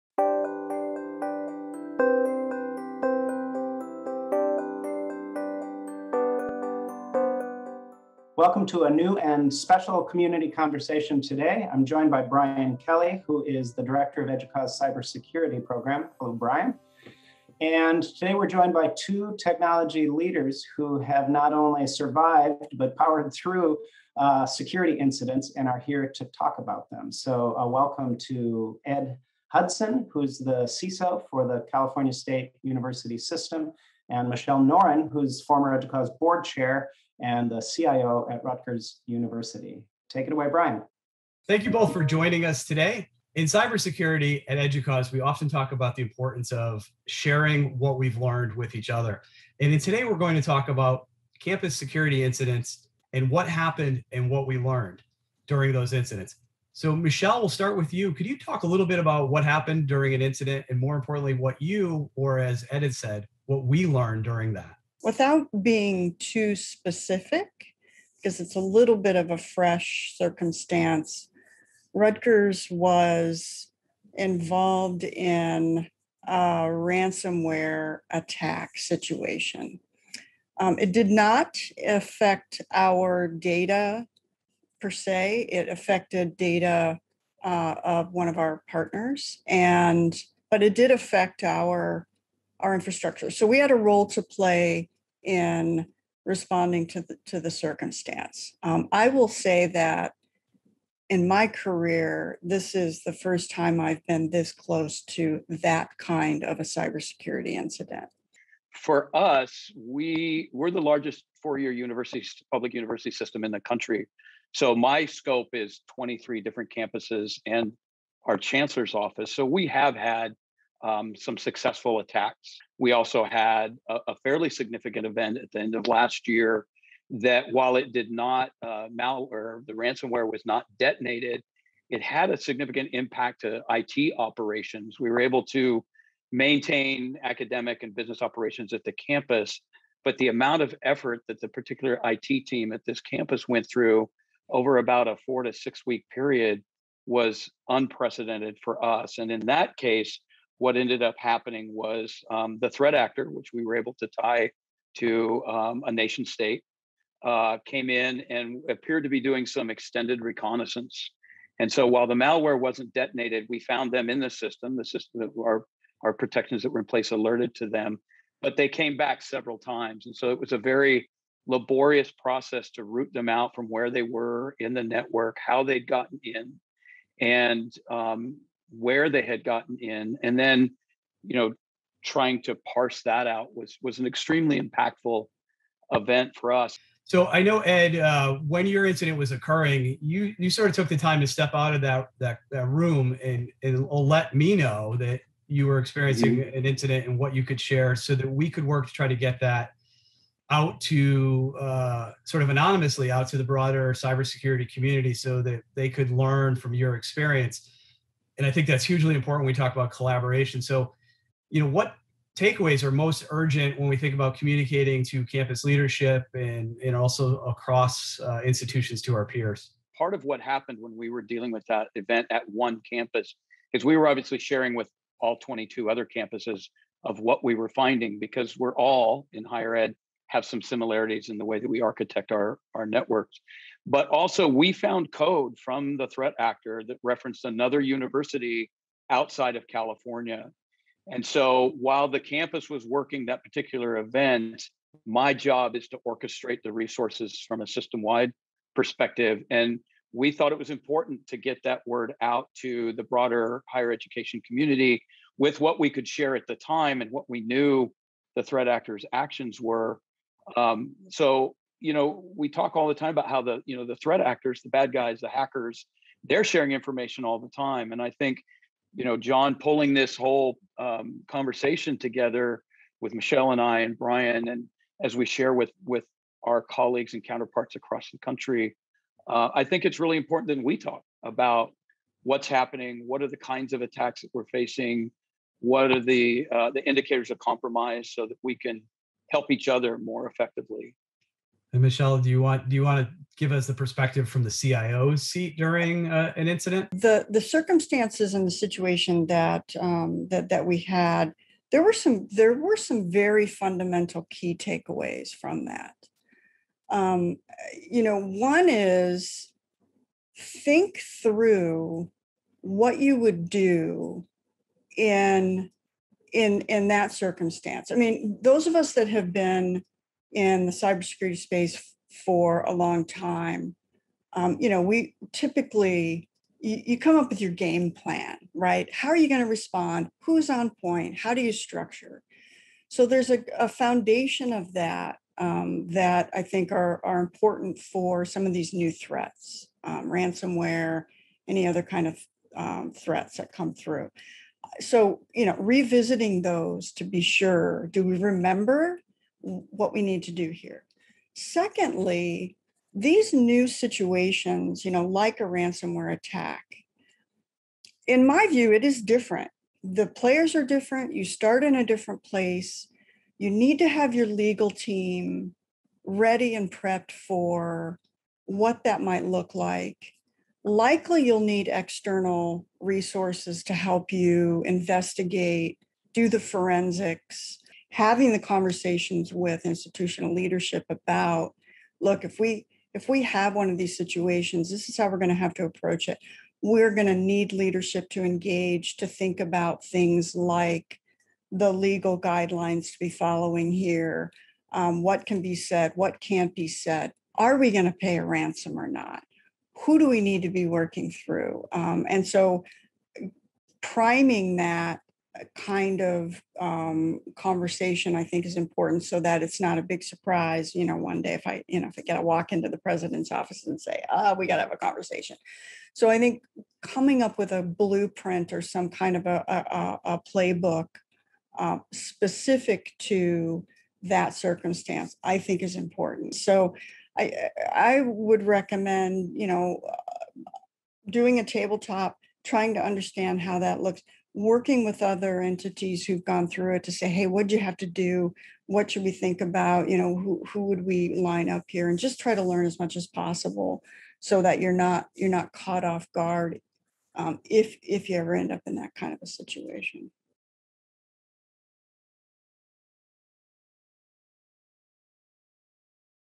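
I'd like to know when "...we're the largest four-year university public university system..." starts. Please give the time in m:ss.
1:50.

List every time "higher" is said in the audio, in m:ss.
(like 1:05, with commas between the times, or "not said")
3:49, 4:13.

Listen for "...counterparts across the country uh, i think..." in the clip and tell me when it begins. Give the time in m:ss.
4:37.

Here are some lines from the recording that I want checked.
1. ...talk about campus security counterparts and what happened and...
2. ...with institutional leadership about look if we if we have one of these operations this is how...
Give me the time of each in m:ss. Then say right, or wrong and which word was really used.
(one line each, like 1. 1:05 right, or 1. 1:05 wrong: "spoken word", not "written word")
1. 0:50 wrong: "incidents", not "counterparts"
2. 6:19 wrong: "situations", not "operations".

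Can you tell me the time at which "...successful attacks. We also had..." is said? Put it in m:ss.
2:01.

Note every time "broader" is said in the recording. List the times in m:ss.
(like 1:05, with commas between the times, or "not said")
3:23, 4:13.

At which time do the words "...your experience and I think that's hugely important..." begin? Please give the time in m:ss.
3:26.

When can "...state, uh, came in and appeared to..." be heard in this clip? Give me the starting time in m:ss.
2:36.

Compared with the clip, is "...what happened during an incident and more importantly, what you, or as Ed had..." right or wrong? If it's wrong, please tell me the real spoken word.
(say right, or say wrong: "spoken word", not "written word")
right.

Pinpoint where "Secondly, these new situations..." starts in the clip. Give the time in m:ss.
5:51.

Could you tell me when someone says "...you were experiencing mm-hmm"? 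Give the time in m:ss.
3:15.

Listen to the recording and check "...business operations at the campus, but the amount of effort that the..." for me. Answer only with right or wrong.
right.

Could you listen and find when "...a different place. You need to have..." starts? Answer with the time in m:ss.
6:01.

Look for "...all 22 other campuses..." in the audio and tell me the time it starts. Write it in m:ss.
3:45.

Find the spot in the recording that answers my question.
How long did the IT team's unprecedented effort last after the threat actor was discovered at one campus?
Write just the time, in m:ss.
2:25.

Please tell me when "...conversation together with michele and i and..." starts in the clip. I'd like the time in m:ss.
4:31.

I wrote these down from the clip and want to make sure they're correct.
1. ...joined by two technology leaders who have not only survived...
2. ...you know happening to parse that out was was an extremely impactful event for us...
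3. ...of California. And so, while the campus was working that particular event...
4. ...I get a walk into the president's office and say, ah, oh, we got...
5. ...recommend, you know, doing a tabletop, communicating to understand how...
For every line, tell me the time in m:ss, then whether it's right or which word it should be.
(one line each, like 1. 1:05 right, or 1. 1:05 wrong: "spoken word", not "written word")
1. 0:18 right
2. 3:01 wrong: "trying", not "happening"
3. 3:59 right
4. 6:51 right
5. 7:08 wrong: "trying", not "communicating".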